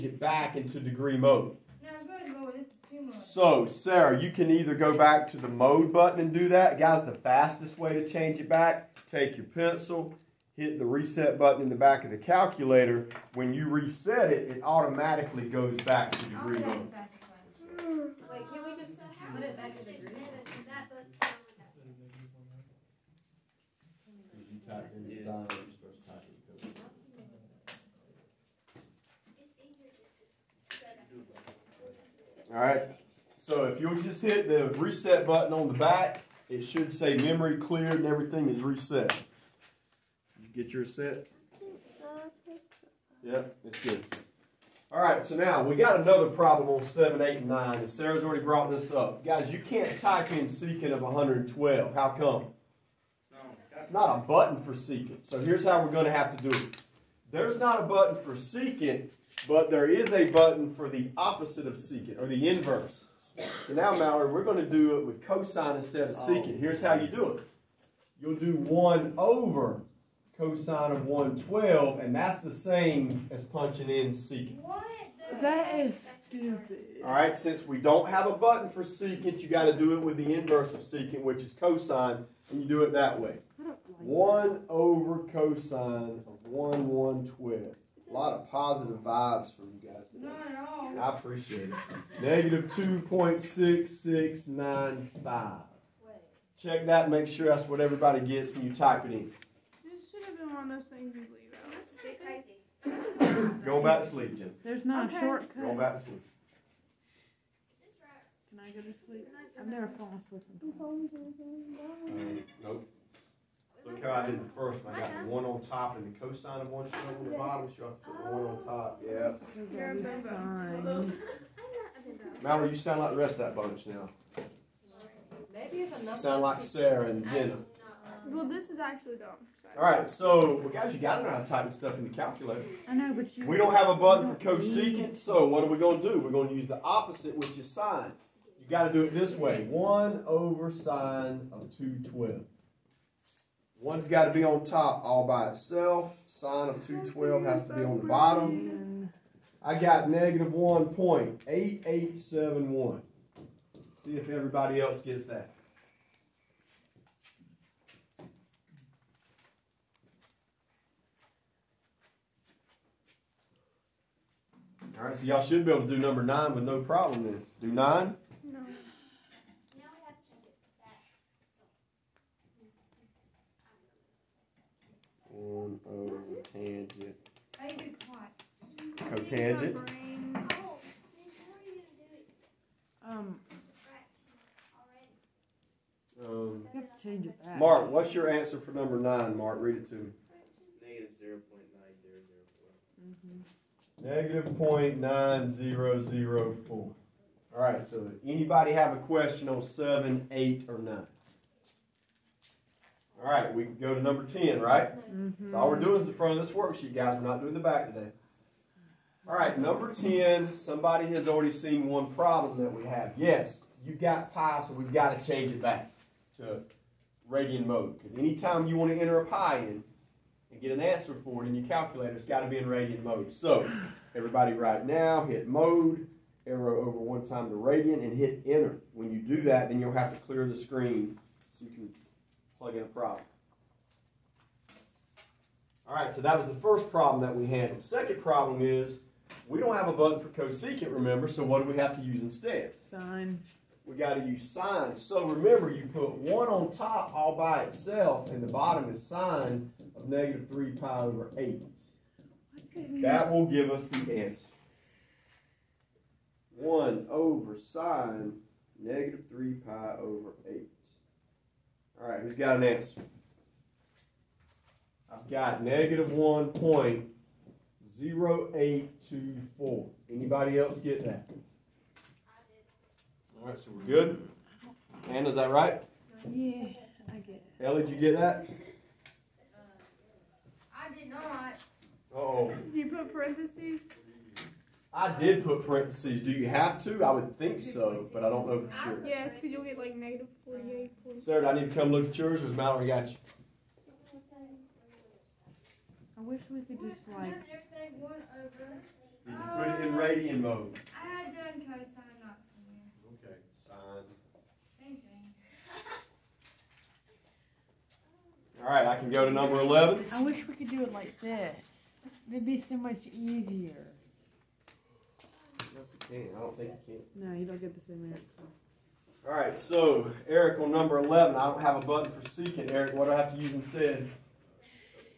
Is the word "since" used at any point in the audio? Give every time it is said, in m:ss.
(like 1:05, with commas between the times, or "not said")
1:17.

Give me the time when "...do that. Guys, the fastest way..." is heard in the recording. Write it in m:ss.
0:06.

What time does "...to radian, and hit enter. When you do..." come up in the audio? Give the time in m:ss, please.
3:47.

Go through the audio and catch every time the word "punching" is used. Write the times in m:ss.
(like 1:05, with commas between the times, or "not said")
1:13.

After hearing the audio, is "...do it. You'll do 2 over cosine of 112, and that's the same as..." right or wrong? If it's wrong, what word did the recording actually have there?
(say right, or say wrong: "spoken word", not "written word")
wrong: "1", not "2".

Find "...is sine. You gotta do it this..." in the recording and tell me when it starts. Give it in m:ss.
2:17.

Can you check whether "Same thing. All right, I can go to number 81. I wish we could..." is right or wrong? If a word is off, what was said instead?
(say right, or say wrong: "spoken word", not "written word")
wrong: "11", not "81".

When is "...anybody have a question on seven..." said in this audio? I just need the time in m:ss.
3:18.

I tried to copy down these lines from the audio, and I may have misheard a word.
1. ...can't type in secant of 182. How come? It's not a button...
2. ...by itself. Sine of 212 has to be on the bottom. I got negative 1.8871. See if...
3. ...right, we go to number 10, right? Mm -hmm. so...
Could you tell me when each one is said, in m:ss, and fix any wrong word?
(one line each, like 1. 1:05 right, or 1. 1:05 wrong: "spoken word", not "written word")
1. 0:49 wrong: "112", not "182"
2. 2:25 right
3. 3:23 right.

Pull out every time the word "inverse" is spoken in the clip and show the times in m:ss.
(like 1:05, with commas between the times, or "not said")
1:02, 1:20.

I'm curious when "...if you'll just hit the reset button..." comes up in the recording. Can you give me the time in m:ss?
0:33.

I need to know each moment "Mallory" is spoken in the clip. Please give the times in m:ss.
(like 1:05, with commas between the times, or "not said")
1:03, 2:02, 4:52.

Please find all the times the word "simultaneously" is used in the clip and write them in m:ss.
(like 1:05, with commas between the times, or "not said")
not said.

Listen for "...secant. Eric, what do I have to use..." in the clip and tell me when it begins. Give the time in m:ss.
5:22.